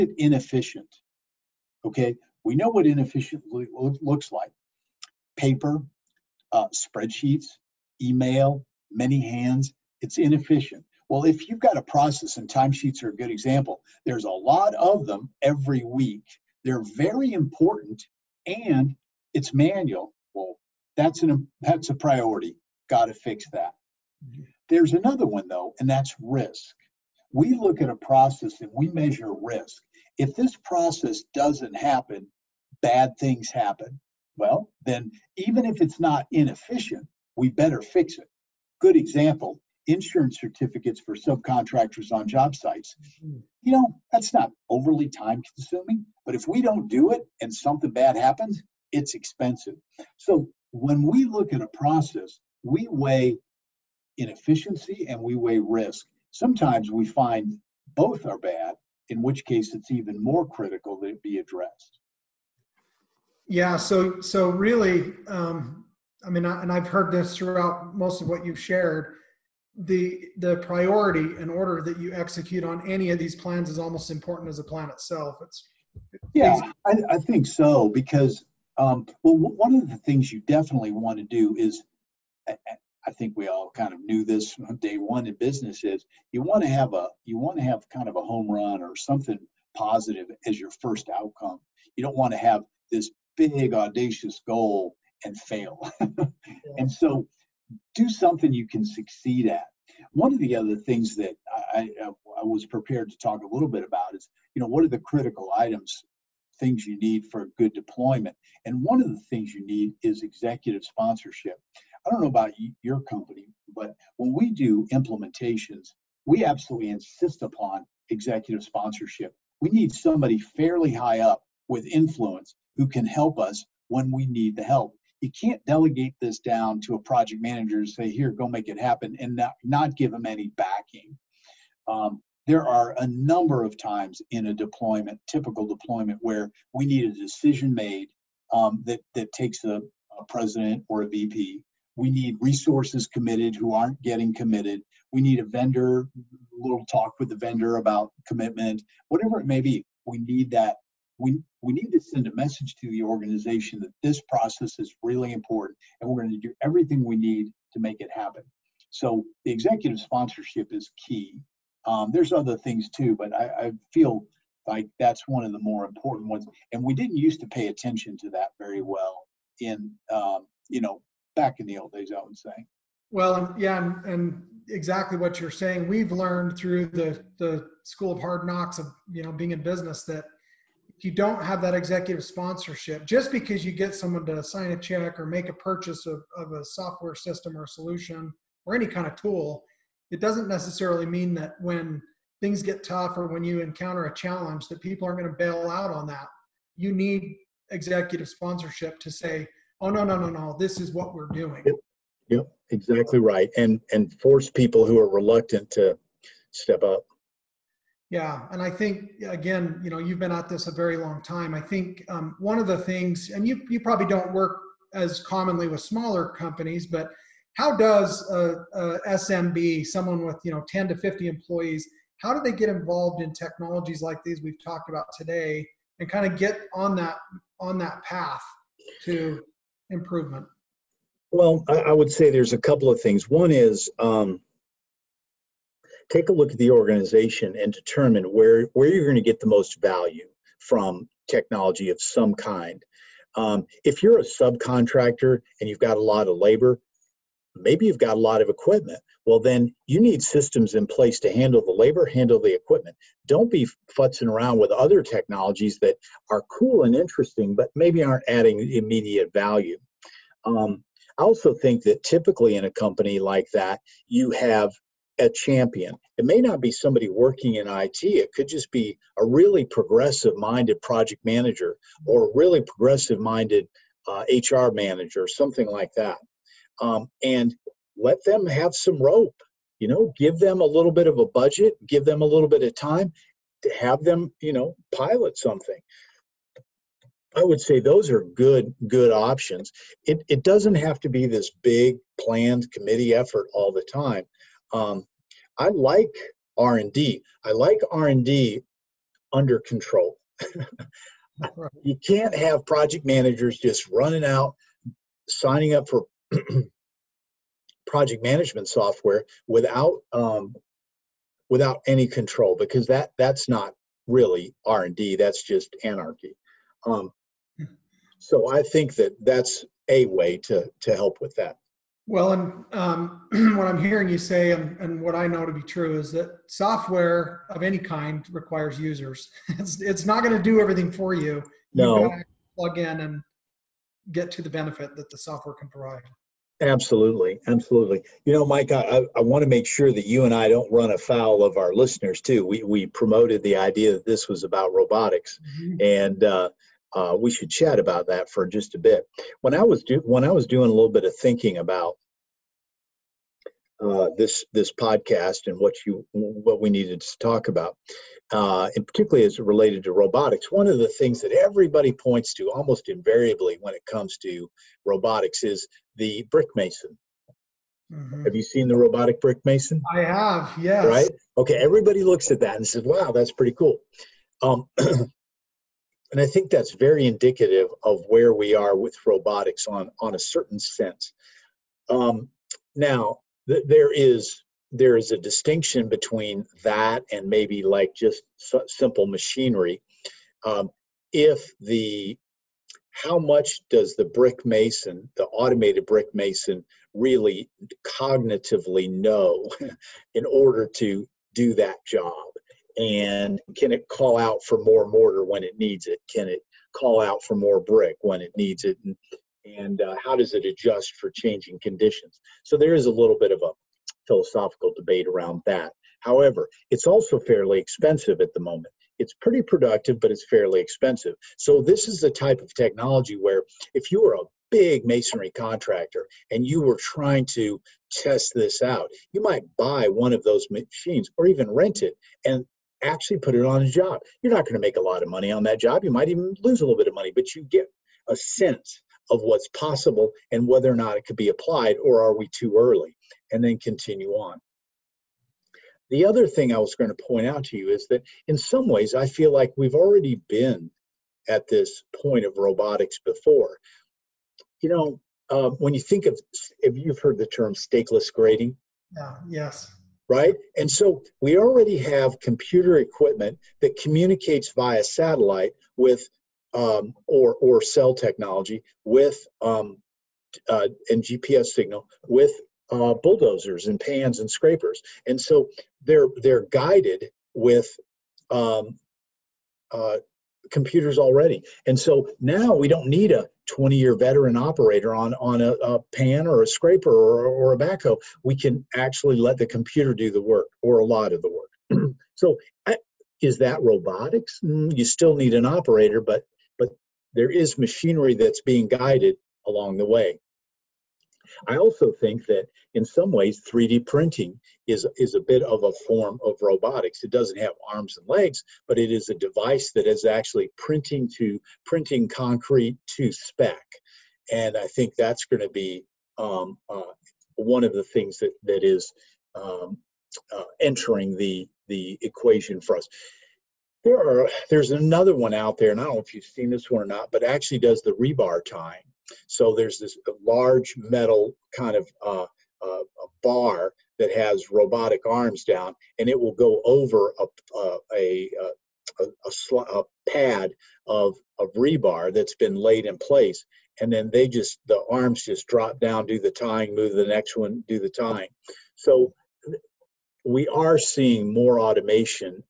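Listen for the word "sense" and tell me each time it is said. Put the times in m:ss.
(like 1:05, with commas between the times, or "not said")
6:20, 7:18.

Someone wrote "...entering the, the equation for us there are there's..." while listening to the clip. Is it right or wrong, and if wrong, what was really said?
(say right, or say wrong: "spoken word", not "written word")
right.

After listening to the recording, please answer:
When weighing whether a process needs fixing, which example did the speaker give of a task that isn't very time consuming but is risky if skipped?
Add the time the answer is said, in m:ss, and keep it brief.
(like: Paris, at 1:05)
Insurance certificates for subcontractors, at 0:39.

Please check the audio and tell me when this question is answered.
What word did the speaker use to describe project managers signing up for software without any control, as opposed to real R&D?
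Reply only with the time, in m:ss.
5:15.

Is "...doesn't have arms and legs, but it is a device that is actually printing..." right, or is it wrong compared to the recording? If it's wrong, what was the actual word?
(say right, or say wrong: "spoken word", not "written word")
right.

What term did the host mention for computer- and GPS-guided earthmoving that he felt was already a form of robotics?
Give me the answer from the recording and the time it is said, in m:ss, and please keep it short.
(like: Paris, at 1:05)
Stakeless grading, at 7:37.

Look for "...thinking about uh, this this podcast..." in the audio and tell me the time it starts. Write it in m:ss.
5:51.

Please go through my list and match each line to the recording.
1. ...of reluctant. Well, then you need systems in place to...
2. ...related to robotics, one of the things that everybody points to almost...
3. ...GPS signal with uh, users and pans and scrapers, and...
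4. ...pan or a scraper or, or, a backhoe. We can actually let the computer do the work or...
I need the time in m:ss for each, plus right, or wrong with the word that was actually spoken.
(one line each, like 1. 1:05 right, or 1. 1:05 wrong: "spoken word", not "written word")
1. 4:08 wrong: "equipment", not "reluctant"
2. 5:59 right
3. 7:51 wrong: "bulldozers", not "users"
4. 8:05 right.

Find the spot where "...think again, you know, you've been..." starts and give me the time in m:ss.
3:28.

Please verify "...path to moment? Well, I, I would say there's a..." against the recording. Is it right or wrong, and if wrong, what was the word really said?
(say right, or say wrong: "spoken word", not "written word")
wrong: "improvement", not "moment".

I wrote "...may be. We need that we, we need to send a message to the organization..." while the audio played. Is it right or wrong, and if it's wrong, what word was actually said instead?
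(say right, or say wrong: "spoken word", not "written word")
right.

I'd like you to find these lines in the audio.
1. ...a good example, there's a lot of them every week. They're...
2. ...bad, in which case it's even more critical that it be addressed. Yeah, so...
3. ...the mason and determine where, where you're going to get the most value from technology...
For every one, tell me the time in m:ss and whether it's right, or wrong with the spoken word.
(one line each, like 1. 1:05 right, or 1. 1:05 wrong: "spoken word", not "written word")
1. 0:13 right
2. 0:58 right
3. 3:56 wrong: "organization", not "mason".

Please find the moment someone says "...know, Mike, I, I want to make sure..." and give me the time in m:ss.
5:38.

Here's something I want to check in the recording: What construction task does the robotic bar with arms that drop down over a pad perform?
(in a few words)
Rebar tying.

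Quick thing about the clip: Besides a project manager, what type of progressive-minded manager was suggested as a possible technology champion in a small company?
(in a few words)
HR manager.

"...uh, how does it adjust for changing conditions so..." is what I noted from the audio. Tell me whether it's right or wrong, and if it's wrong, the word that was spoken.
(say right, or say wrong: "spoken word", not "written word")
right.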